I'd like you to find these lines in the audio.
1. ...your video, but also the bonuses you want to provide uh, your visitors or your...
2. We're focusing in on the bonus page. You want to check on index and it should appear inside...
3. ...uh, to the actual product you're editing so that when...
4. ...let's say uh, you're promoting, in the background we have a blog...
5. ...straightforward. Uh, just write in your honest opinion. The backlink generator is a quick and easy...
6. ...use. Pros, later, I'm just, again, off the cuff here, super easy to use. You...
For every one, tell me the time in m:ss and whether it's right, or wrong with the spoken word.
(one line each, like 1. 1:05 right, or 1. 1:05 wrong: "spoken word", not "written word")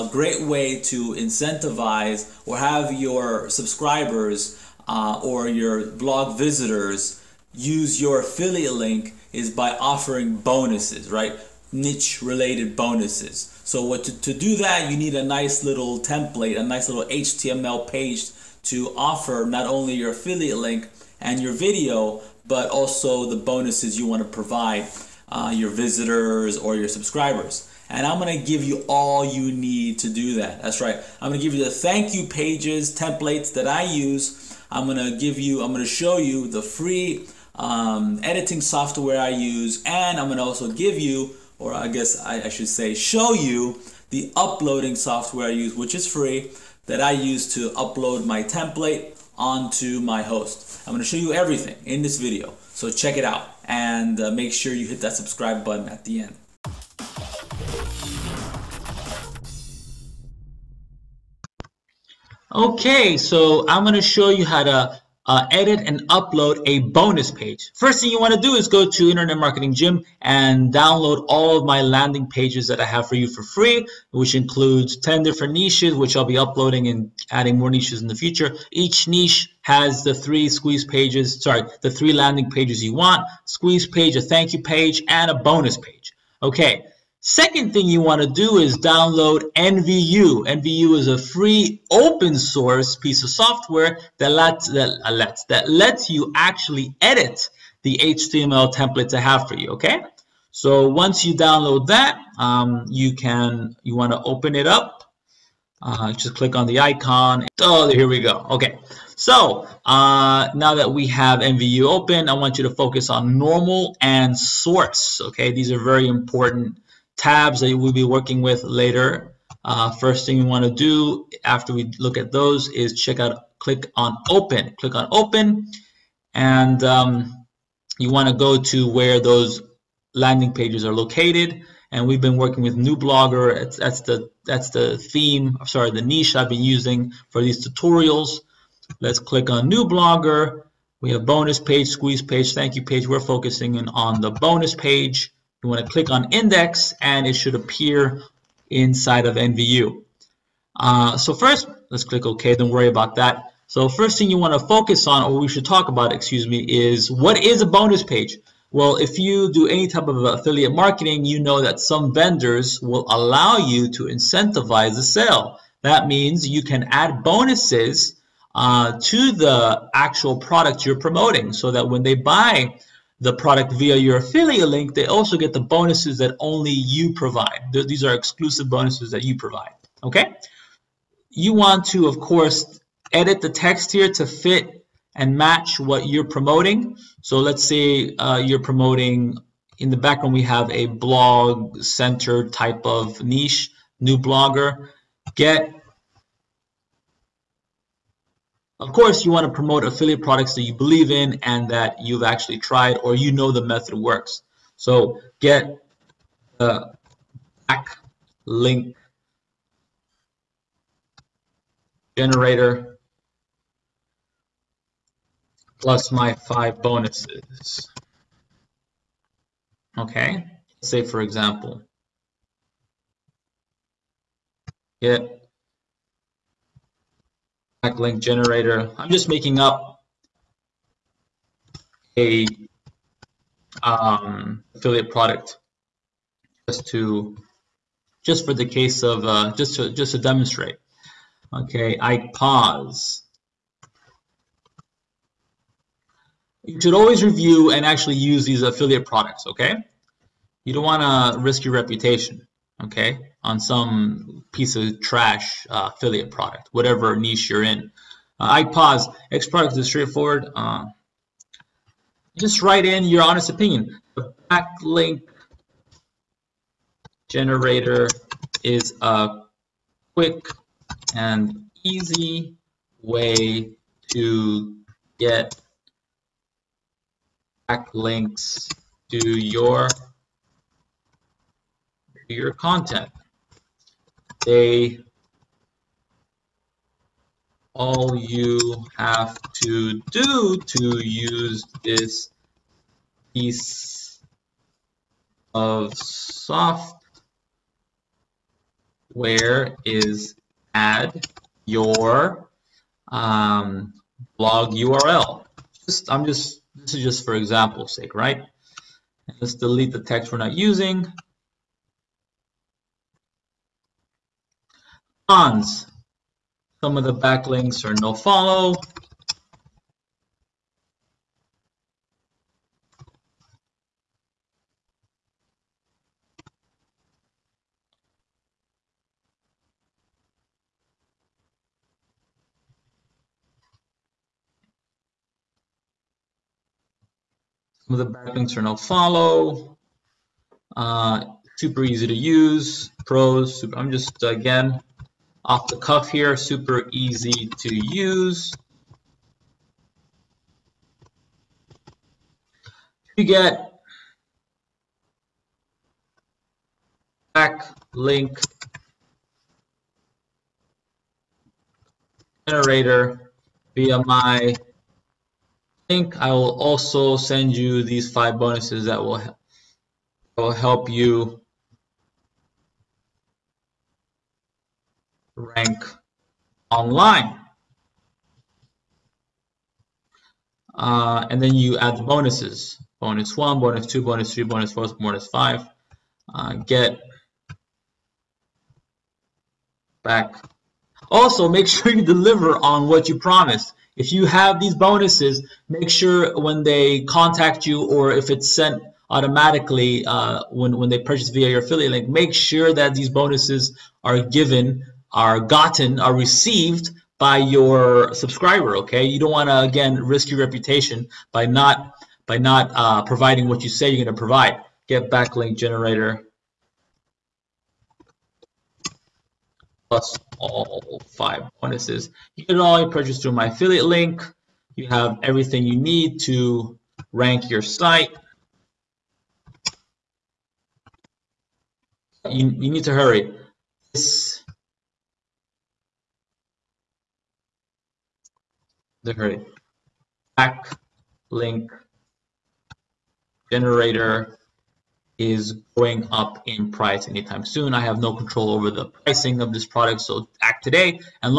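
1. 0:21 right
2. 2:23 wrong: "click", not "check"
3. 2:48 wrong: "promoting", not "editing"
4. 3:07 right
5. 4:19 right
6. 5:42 wrong: "super", not "later".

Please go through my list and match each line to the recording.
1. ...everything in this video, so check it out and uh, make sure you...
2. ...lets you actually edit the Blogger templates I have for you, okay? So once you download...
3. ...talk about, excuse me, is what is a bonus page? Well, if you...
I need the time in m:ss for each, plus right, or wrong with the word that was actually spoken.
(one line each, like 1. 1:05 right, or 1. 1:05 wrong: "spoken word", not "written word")
1. 0:51 right
2. 1:35 wrong: "HTML", not "Blogger"
3. 2:35 right.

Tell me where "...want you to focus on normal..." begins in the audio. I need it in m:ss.
1:52.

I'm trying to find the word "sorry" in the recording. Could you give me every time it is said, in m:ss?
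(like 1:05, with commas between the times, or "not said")
1:21, 2:15.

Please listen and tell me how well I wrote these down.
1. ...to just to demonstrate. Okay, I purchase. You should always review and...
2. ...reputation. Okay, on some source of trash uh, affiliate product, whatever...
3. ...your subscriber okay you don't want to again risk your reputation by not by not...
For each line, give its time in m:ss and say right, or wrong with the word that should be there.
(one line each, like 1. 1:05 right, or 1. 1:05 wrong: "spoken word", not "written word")
1. 3:59 wrong: "pause", not "purchase"
2. 4:11 wrong: "piece", not "source"
3. 6:47 right.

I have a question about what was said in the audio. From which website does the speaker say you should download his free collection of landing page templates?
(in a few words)
Internet Marketing Gym.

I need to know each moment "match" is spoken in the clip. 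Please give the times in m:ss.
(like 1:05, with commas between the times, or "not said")
3:05.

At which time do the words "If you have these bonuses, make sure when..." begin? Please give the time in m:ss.
6:33.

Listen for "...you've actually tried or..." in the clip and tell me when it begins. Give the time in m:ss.
3:22.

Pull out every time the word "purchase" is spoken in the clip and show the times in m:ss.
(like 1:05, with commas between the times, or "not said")
6:41, 7:02.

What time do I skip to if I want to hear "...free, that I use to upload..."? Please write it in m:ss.
0:46.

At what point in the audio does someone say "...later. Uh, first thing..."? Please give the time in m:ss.
1:58.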